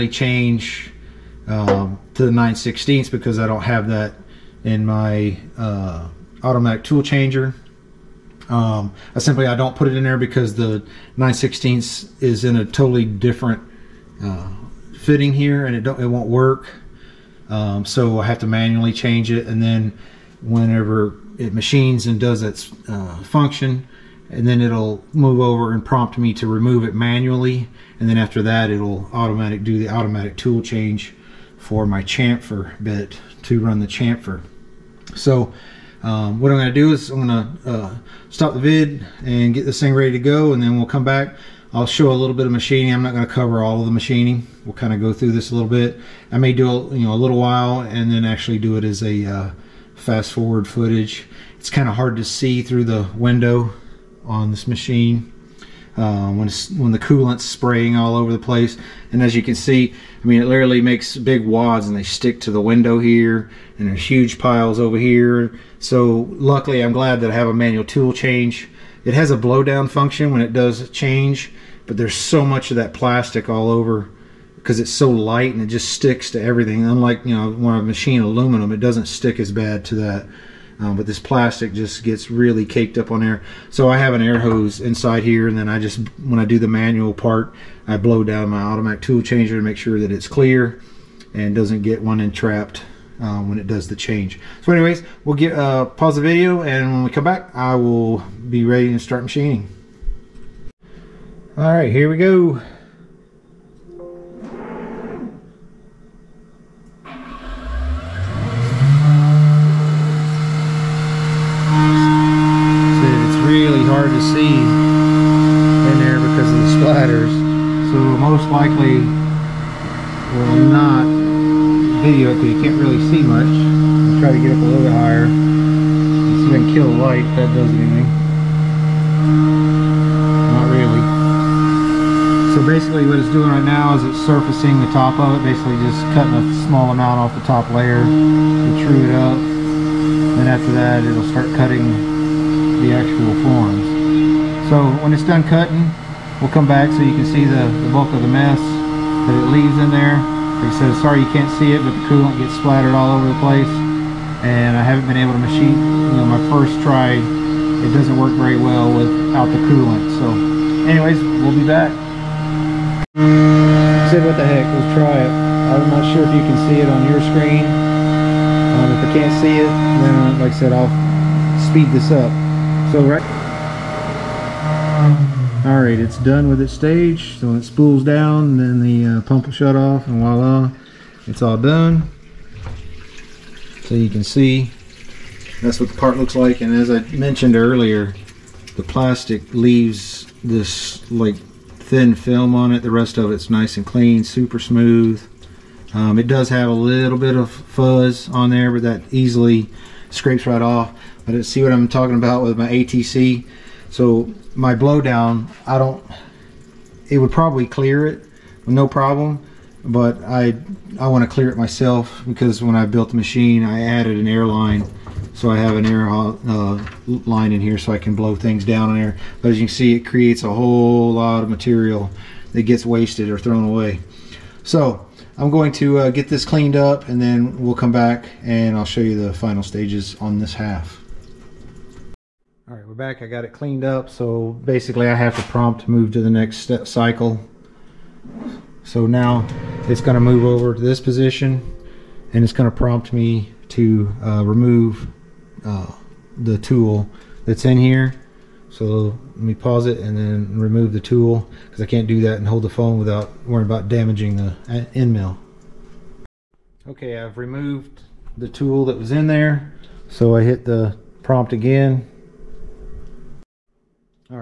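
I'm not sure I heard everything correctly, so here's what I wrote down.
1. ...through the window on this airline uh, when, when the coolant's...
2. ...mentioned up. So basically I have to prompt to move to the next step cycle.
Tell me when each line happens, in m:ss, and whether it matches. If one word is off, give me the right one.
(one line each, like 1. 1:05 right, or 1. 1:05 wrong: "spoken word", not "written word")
1. 0:52 wrong: "machine", not "airline"
2. 3:53 wrong: "cleaned", not "mentioned".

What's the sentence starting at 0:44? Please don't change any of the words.
We'll kind of go through this a little bit.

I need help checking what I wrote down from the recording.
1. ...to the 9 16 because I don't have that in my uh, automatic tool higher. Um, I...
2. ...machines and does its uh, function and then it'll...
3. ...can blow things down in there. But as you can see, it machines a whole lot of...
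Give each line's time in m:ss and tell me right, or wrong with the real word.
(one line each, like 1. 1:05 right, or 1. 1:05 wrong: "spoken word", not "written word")
1. 0:02 wrong: "changer", not "higher"
2. 0:21 right
3. 3:37 wrong: "creates", not "machines".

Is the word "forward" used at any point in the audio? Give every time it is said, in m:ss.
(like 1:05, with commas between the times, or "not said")
0:50.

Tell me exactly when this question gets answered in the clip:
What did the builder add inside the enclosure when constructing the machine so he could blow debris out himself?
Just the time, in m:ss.
3:34.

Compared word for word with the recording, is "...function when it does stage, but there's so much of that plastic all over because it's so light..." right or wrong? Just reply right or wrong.
wrong.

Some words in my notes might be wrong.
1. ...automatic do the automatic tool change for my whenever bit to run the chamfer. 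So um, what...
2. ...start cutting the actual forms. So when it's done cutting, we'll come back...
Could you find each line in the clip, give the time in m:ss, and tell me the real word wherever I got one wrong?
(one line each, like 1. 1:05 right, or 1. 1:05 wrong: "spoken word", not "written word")
1. 0:29 wrong: "chamfer", not "whenever"
2. 2:21 right.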